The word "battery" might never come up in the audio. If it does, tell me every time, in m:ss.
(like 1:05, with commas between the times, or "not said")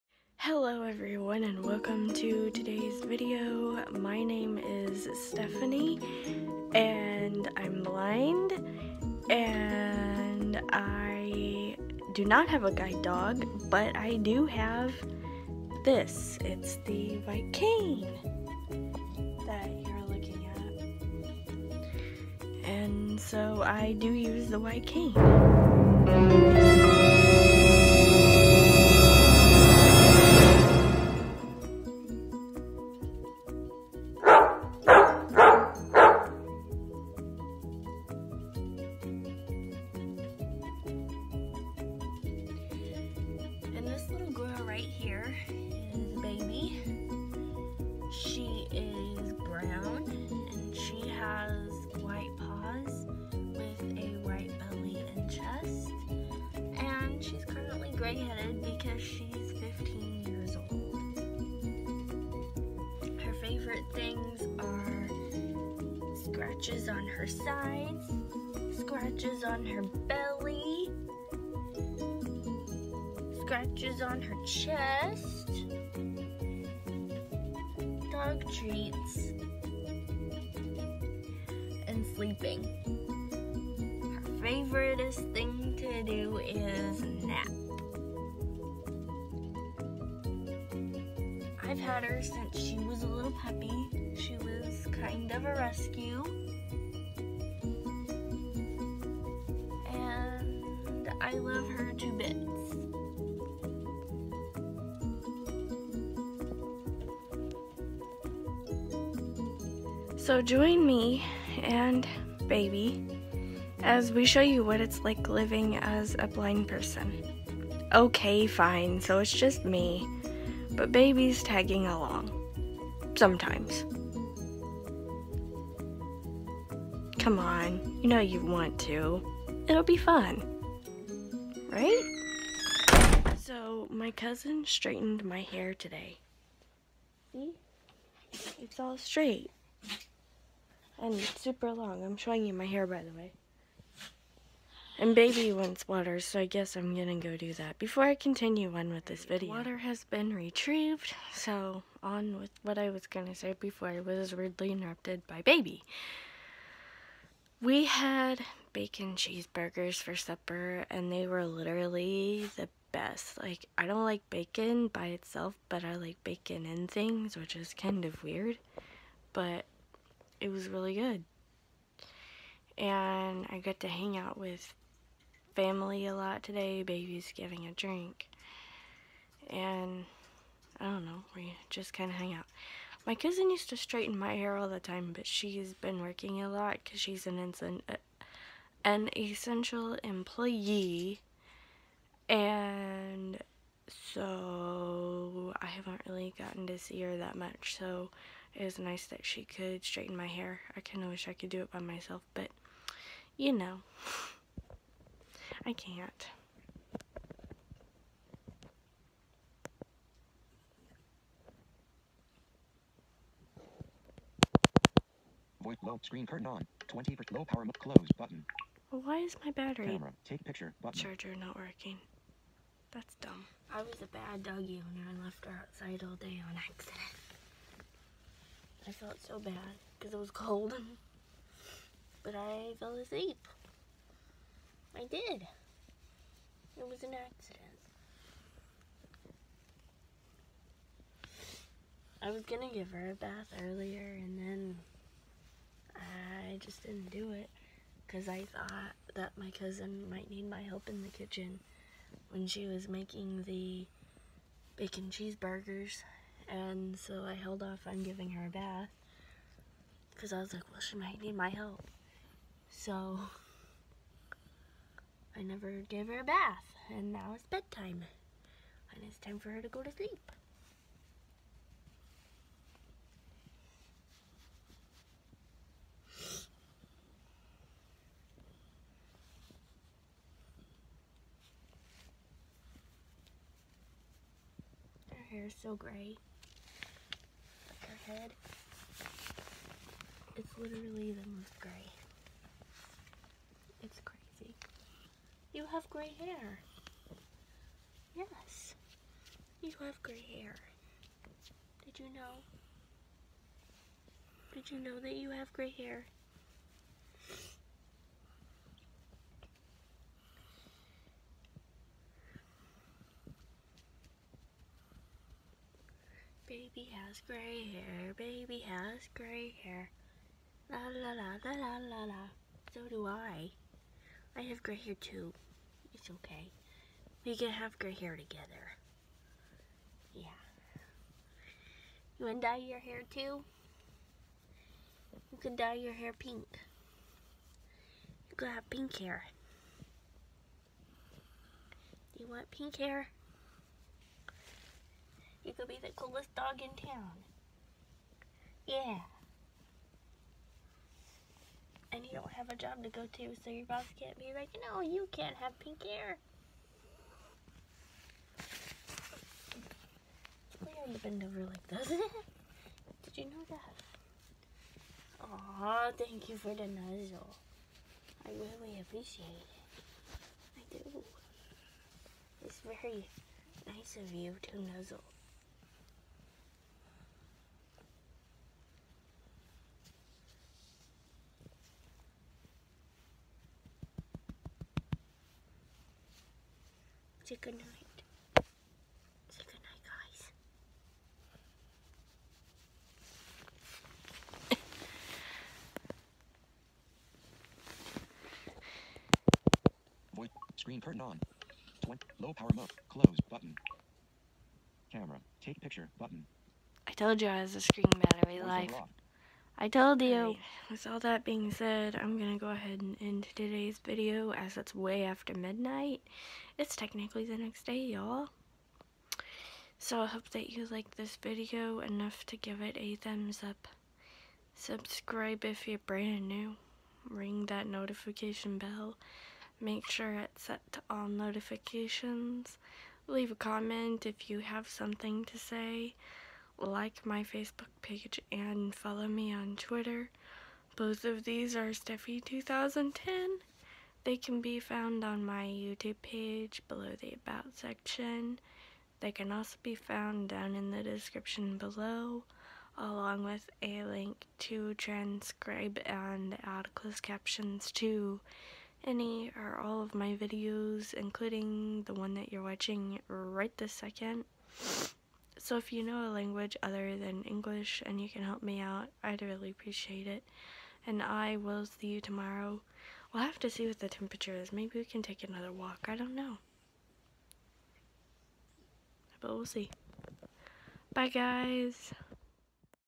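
3:39, 6:47.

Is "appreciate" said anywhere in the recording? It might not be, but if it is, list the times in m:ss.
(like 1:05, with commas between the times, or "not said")
6:08, 7:49.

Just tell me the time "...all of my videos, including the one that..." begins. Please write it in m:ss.
7:39.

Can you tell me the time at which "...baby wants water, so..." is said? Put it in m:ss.
2:25.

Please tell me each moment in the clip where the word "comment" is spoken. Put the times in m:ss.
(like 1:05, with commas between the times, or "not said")
7:13.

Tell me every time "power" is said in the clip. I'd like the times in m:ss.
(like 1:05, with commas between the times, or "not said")
3:37, 6:42.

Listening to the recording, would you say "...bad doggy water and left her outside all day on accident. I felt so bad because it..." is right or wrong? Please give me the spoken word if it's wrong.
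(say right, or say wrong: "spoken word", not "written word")
wrong: "owner", not "water".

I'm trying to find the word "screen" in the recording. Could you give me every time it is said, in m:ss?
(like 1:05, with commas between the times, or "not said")
3:36, 6:40, 6:47.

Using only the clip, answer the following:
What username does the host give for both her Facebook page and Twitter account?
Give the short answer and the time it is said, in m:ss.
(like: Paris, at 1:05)
Stephie2010, at 7:21.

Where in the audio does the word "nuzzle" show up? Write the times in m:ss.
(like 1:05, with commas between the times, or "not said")
6:06, 6:14.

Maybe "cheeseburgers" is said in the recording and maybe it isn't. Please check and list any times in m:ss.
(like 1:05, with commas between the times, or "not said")
2:39, 4:15.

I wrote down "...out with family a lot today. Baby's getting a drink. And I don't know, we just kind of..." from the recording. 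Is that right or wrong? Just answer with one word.
right.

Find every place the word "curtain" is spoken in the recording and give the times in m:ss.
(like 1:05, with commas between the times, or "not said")
3:36, 6:40.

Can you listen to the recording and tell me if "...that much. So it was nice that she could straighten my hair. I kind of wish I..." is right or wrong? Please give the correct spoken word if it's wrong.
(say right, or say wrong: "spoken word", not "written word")
right.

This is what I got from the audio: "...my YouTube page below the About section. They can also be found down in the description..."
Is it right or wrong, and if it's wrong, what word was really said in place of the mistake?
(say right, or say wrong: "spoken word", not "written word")
right.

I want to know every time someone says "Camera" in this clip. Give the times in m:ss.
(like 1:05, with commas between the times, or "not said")
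3:39, 6:44.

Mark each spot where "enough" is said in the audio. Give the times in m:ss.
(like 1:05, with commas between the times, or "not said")
7:01.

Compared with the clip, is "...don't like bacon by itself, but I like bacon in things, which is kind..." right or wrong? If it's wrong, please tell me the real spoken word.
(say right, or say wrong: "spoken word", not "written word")
right.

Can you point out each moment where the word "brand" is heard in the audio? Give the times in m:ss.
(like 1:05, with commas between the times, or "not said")
7:05.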